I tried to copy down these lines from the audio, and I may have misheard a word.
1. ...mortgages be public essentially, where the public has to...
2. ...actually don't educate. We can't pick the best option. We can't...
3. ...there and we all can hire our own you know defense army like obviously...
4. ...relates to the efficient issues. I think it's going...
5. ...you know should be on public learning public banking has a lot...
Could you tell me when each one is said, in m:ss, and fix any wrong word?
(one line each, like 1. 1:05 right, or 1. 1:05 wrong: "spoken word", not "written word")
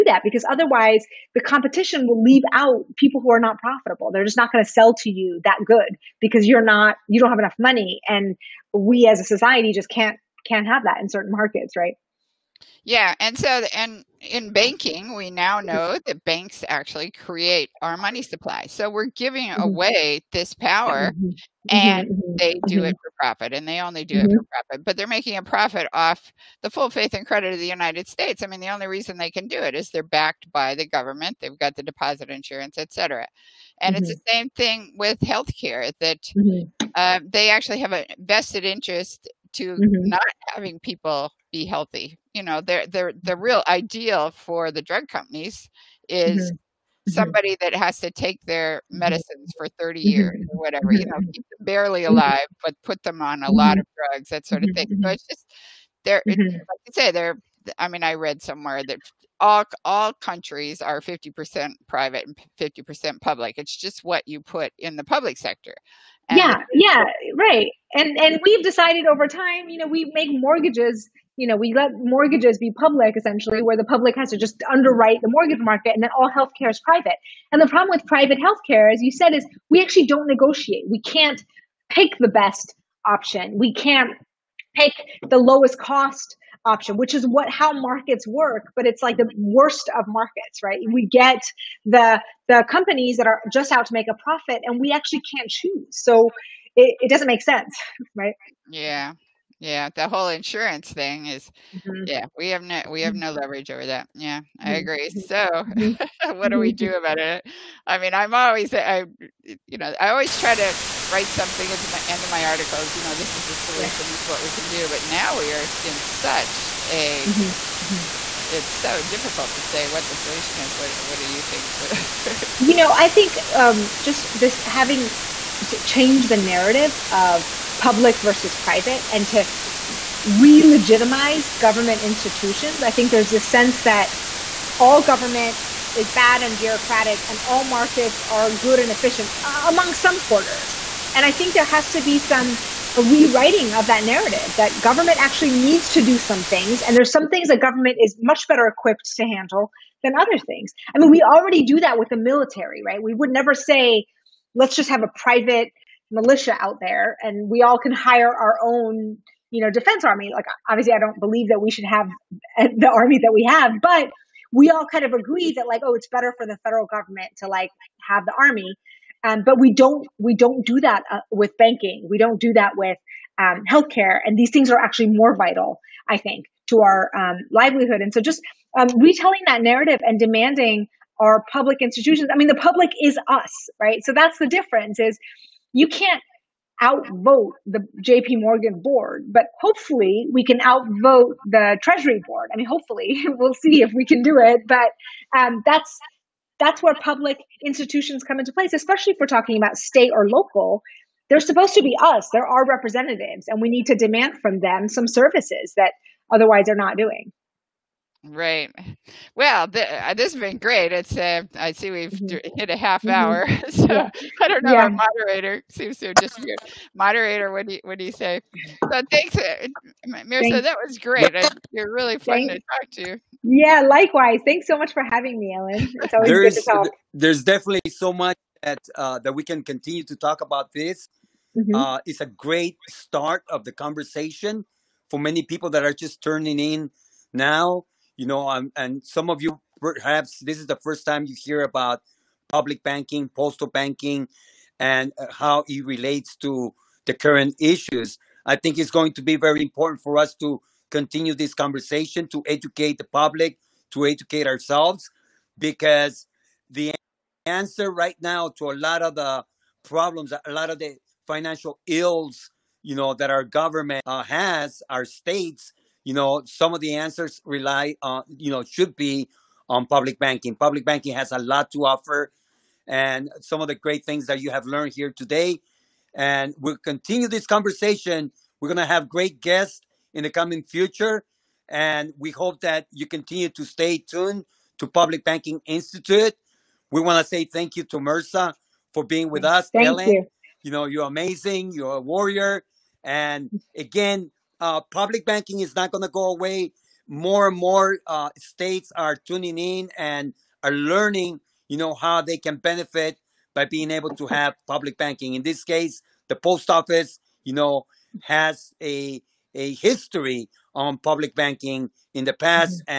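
1. 1:11 right
2. 1:19 wrong: "negotiate", not "educate"
3. 2:36 right
4. 4:05 wrong: "current", not "efficient"
5. 4:28 wrong: "banking", not "learning".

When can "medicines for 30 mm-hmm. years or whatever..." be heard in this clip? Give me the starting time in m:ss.
0:48.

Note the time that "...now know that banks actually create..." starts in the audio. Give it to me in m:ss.
0:15.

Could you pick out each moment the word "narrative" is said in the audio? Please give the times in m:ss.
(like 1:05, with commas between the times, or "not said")
2:06, 2:24, 2:59.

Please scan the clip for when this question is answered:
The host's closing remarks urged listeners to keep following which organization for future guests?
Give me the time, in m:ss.
4:44.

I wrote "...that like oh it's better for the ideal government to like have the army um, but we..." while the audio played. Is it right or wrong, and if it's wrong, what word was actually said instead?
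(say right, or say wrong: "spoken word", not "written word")
wrong: "federal", not "ideal".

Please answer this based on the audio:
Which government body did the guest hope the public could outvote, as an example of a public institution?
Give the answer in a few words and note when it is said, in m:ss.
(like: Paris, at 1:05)
Treasury board, at 3:11.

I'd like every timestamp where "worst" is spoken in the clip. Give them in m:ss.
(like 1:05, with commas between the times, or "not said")
1:29.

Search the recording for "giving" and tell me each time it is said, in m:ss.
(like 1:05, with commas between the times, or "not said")
0:19.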